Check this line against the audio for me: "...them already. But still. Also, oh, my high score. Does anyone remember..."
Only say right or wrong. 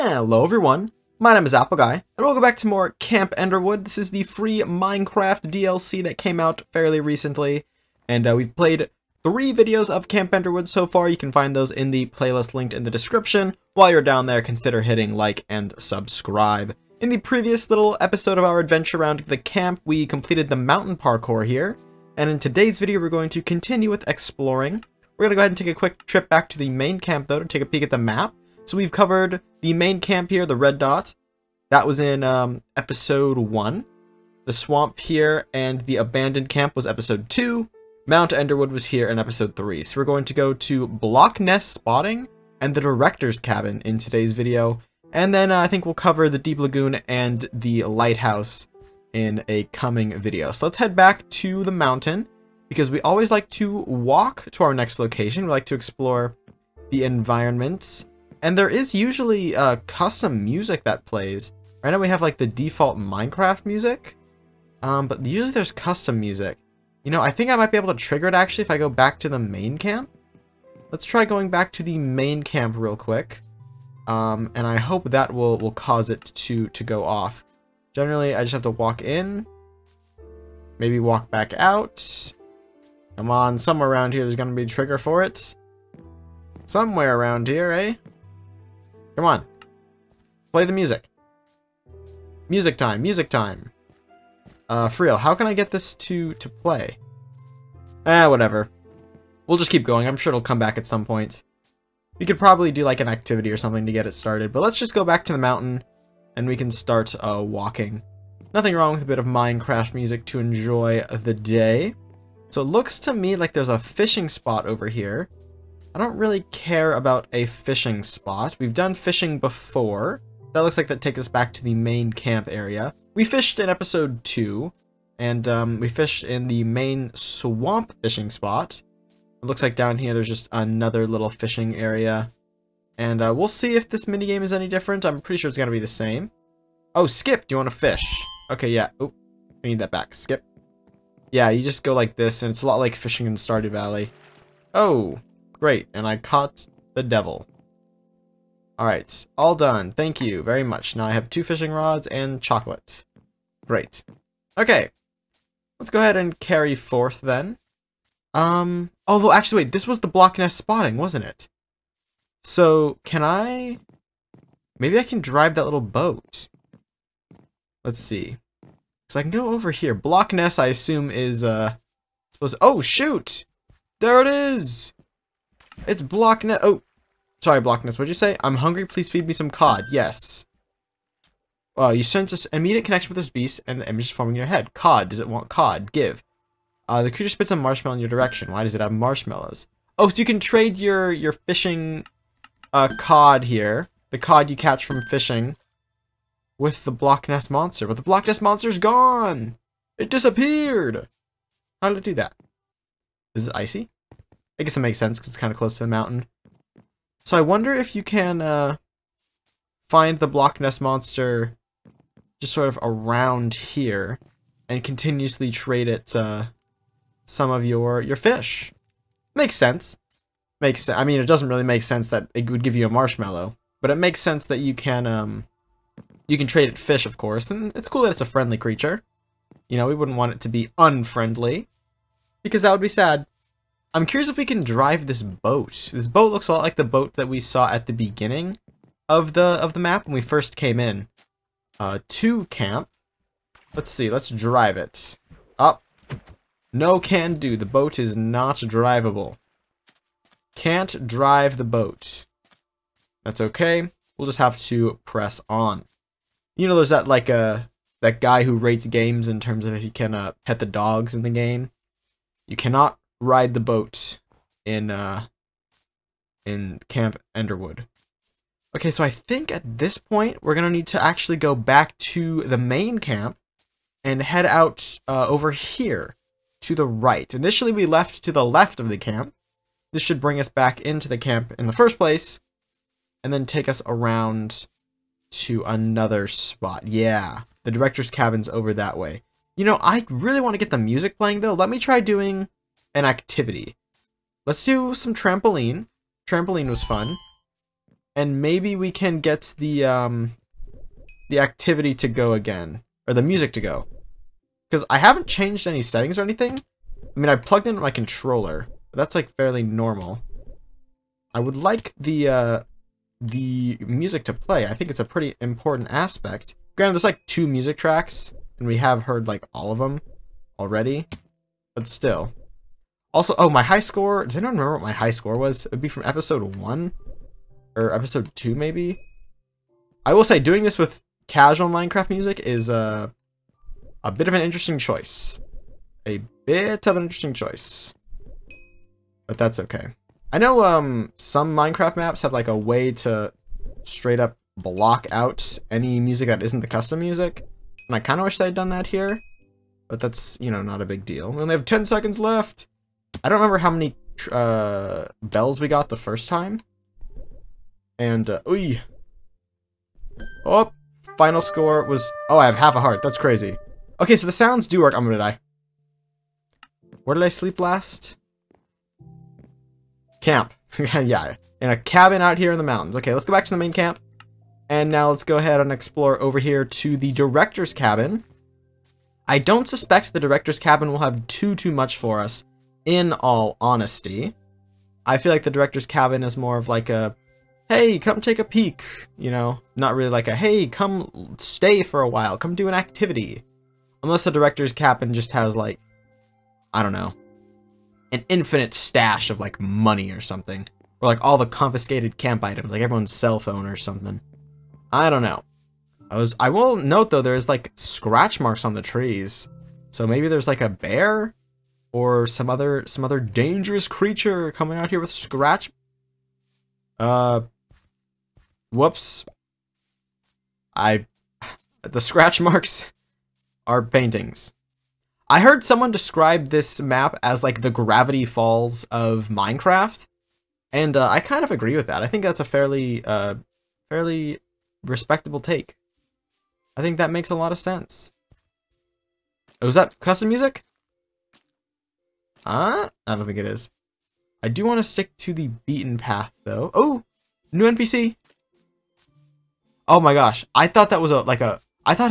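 right.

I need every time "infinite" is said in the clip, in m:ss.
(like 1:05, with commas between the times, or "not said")
6:38.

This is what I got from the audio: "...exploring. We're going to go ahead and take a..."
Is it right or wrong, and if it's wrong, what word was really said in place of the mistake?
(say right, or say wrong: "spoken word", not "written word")
right.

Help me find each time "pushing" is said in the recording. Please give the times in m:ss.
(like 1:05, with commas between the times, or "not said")
not said.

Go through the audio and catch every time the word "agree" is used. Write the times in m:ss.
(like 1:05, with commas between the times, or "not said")
7:11.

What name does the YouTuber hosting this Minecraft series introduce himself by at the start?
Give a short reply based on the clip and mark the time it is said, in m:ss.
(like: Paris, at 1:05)
Appleguy, at 0:01.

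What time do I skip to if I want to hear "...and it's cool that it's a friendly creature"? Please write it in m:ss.
3:47.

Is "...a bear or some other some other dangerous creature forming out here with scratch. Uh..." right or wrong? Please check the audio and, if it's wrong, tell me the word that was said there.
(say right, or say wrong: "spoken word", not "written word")
wrong: "coming", not "forming".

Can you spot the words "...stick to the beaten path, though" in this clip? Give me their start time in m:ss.
7:24.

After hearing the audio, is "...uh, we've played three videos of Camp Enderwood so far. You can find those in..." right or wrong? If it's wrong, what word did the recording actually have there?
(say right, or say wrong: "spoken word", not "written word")
right.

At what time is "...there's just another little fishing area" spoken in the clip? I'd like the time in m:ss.
2:10.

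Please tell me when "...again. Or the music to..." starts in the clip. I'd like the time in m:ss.
5:02.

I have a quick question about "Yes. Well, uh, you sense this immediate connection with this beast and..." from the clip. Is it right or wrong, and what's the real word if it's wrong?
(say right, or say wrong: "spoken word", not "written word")
right.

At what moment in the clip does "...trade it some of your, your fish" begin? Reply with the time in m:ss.
3:35.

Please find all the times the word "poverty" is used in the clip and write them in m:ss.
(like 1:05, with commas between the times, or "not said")
not said.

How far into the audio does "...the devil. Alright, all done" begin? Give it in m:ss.
2:26.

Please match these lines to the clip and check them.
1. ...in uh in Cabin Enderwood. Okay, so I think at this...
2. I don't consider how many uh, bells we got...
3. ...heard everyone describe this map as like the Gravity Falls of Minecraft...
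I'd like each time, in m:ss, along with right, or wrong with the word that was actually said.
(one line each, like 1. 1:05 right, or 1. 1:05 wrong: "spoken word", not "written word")
1. 4:24 wrong: "Camp", not "Cabin"
2. 5:53 wrong: "remember", not "consider"
3. 7:05 wrong: "someone", not "everyone".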